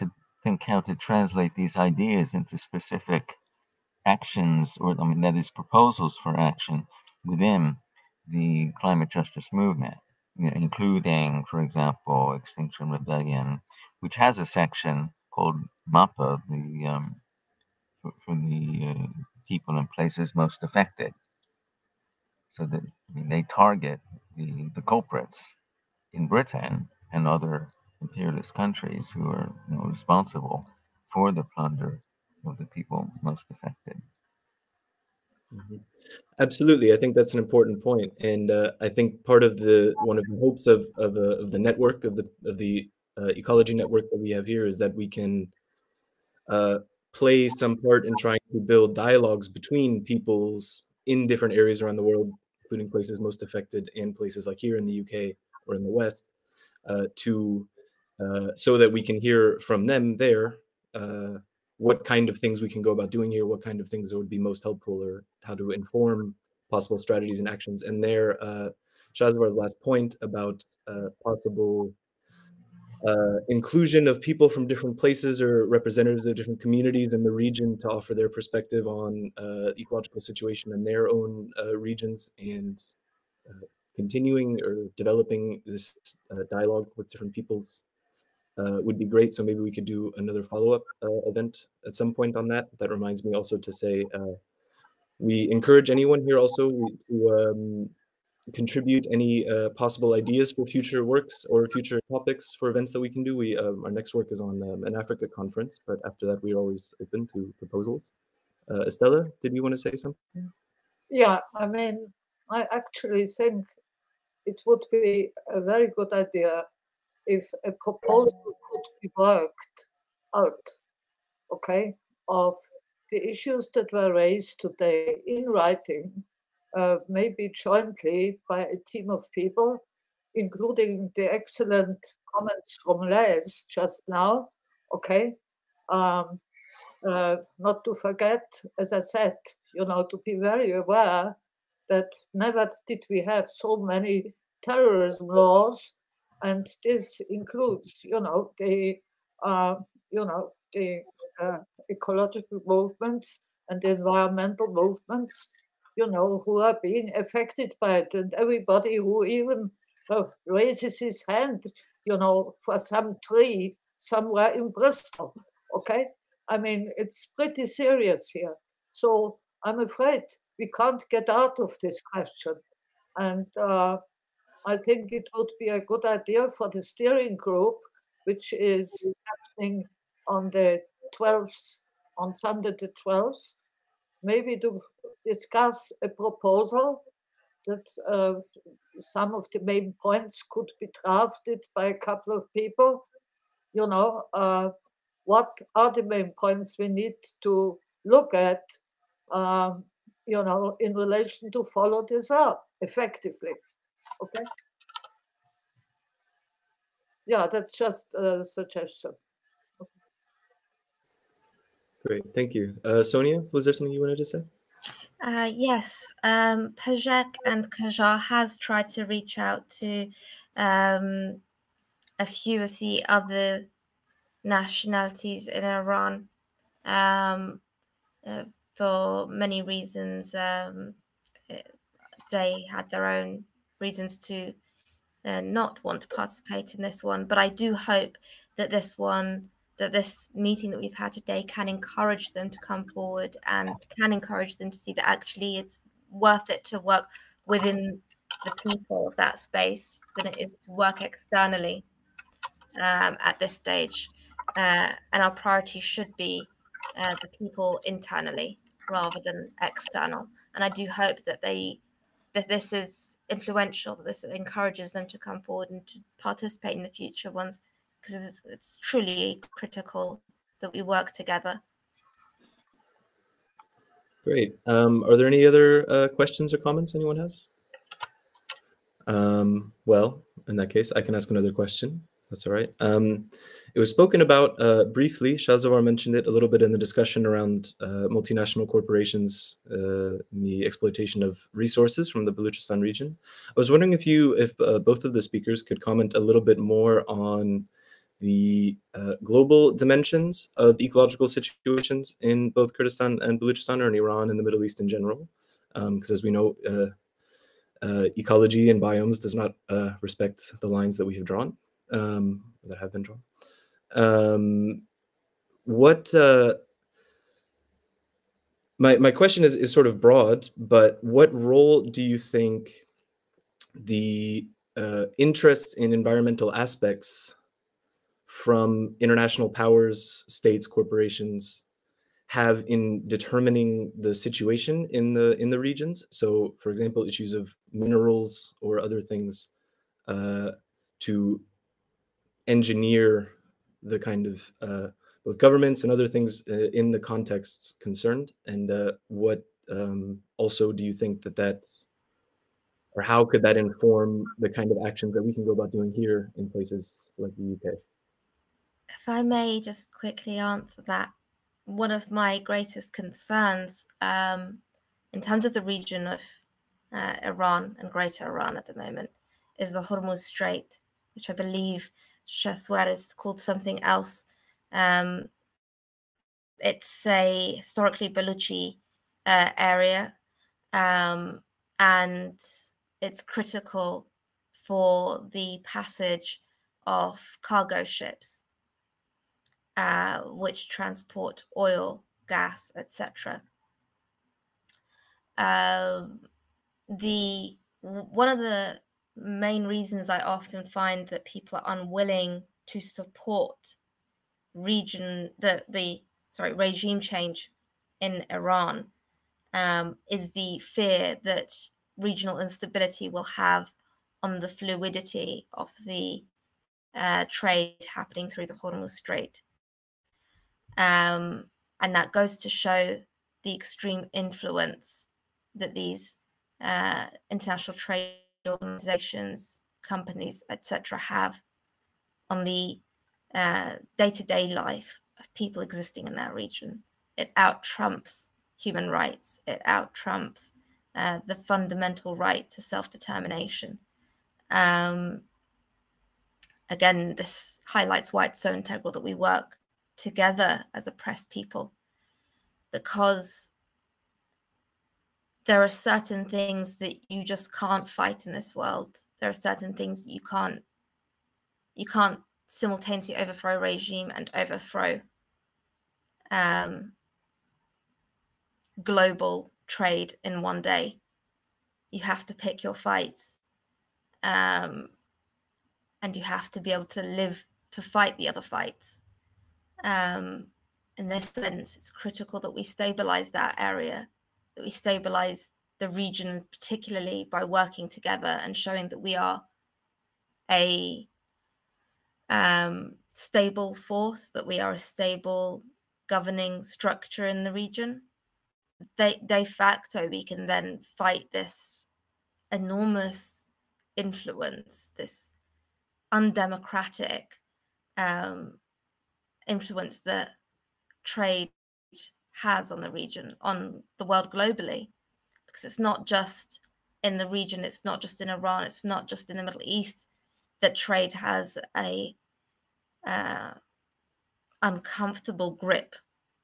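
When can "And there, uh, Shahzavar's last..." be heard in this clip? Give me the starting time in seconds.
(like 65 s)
67 s.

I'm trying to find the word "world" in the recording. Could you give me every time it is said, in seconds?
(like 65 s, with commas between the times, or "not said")
52 s, 458 s, 514 s.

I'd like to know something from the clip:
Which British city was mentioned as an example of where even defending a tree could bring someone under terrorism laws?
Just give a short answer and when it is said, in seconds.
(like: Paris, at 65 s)
Bristol, at 164 s.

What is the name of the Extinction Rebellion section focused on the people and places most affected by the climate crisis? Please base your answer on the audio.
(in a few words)
MAPA.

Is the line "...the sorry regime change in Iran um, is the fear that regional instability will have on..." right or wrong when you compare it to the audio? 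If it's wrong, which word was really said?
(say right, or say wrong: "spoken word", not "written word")
right.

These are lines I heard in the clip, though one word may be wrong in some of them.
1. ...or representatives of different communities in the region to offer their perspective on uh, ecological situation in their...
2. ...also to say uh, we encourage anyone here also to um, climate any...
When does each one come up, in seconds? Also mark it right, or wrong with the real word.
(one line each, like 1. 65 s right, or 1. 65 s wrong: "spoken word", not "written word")
1. 75 s right
2. 93 s wrong: "contribute", not "climate".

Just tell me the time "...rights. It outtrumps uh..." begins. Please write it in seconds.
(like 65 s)
438 s.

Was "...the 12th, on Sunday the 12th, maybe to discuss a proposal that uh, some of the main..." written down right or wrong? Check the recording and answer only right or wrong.
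right.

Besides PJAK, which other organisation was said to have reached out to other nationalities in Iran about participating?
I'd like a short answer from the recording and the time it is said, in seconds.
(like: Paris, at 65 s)
KJAR, at 217 s.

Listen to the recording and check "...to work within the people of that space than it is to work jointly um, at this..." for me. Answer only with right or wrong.
wrong.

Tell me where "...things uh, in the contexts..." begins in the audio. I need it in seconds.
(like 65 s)
346 s.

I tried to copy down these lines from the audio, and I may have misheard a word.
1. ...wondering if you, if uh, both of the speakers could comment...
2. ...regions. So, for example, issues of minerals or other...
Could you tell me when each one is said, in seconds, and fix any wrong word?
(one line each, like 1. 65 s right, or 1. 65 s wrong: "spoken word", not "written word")
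1. 293 s right
2. 335 s right.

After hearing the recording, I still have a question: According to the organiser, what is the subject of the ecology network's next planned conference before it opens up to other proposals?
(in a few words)
Africa.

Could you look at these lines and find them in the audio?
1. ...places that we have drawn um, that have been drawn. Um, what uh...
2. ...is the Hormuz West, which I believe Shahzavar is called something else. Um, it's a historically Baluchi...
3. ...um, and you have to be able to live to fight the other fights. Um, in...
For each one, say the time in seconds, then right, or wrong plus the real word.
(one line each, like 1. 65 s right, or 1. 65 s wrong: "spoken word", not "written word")
1. 310 s wrong: "lines", not "places"
2. 369 s wrong: "Strait", not "West"
3. 474 s right.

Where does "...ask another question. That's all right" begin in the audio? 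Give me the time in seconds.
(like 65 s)
281 s.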